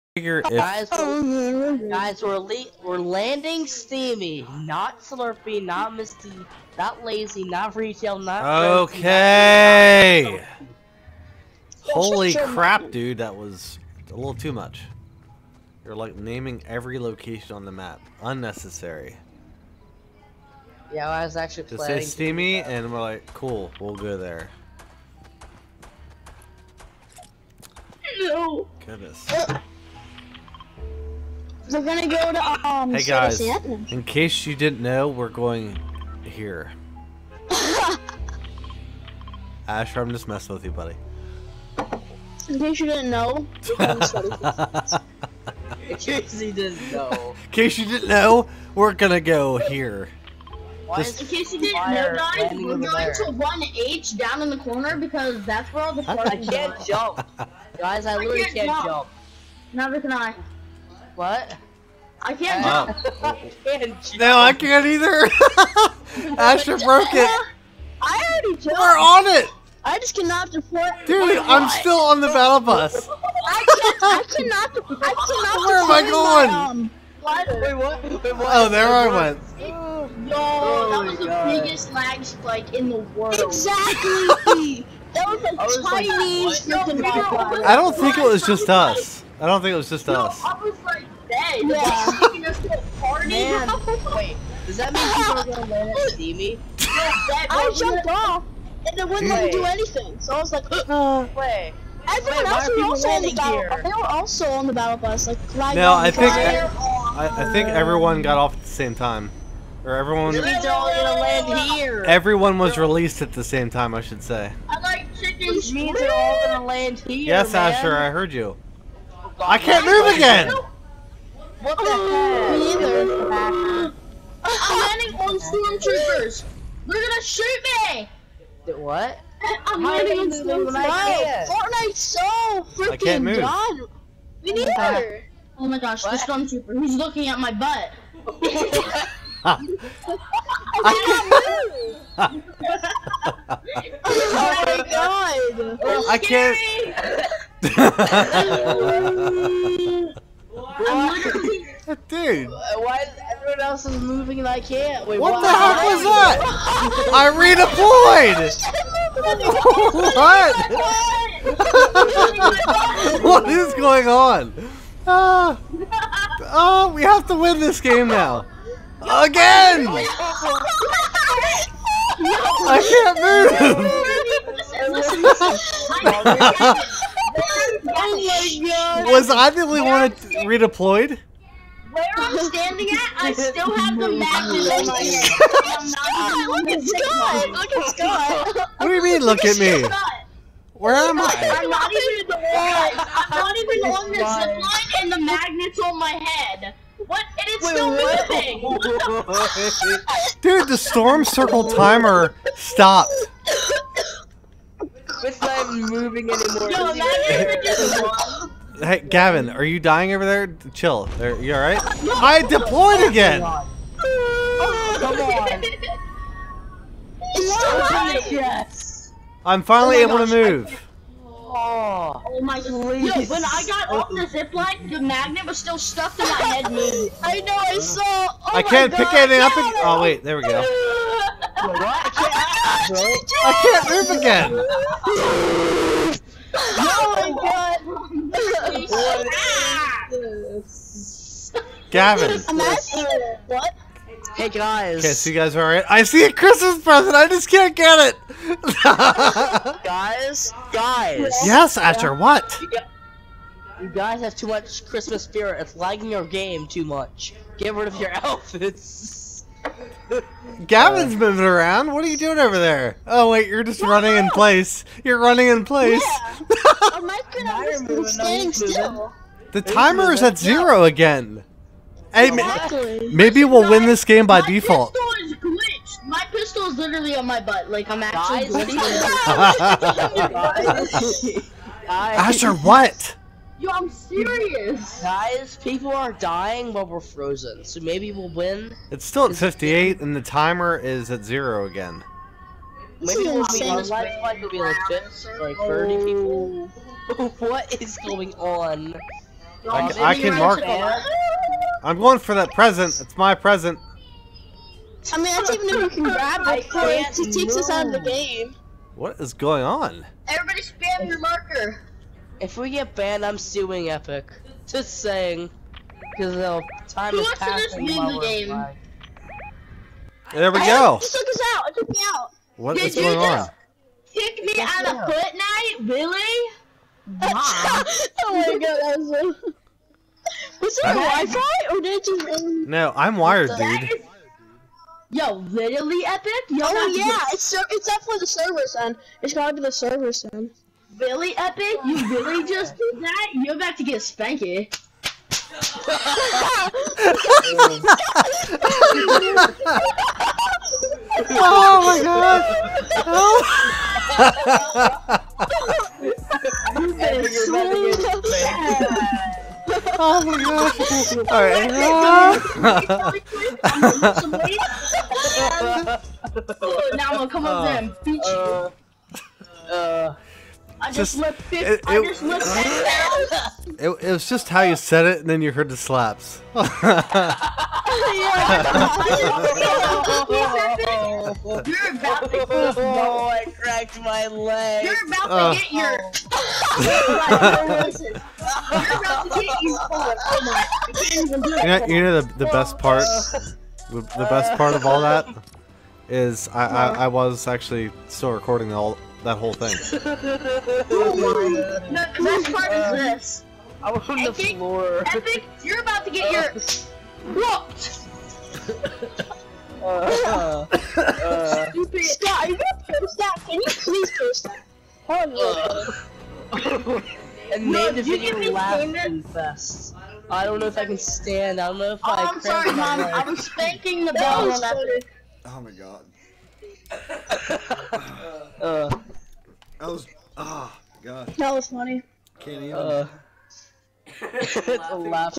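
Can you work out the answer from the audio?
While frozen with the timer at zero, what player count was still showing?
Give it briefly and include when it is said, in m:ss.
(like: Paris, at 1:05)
58, at 4:48.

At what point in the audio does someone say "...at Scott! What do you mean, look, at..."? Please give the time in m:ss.
3:07.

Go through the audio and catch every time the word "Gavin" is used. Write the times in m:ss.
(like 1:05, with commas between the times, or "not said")
3:29, 4:01, 4:20.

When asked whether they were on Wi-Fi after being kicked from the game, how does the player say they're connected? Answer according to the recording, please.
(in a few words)
Wired.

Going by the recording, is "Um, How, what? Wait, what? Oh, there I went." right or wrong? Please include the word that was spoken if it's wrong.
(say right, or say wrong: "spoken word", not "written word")
wrong: "Wait", not "How".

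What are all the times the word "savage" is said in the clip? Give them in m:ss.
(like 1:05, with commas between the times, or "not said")
not said.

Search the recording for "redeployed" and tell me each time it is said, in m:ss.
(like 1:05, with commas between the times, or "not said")
2:37, 3:00.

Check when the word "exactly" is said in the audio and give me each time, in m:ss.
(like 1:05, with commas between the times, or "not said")
1:23, 4:32.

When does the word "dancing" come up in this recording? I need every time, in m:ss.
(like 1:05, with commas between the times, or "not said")
not said.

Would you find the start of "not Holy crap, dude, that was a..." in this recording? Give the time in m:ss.
0:10.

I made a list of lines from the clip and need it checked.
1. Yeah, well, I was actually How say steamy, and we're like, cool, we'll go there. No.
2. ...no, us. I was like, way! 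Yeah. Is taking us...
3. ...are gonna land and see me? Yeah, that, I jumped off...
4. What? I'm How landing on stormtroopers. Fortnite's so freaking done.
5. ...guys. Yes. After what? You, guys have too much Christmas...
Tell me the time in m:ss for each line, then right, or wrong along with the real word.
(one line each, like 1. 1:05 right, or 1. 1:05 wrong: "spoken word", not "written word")
1. 0:20 wrong: "Just", not "How"
2. 1:30 right
3. 1:35 right
4. 2:08 right
5. 4:10 right.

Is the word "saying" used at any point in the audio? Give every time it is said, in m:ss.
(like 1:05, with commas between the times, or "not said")
5:15.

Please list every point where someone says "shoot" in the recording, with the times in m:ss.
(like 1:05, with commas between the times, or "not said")
2:07.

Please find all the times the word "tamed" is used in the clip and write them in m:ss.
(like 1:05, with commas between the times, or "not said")
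not said.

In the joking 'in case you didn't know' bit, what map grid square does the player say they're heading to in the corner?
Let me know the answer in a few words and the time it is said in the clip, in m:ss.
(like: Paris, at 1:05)
1H, at 0:53.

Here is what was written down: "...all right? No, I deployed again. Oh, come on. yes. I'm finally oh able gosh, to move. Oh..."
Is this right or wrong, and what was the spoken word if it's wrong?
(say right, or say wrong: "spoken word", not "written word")
right.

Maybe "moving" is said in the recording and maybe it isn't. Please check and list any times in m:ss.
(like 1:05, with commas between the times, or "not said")
2:34, 3:19, 3:25, 4:21.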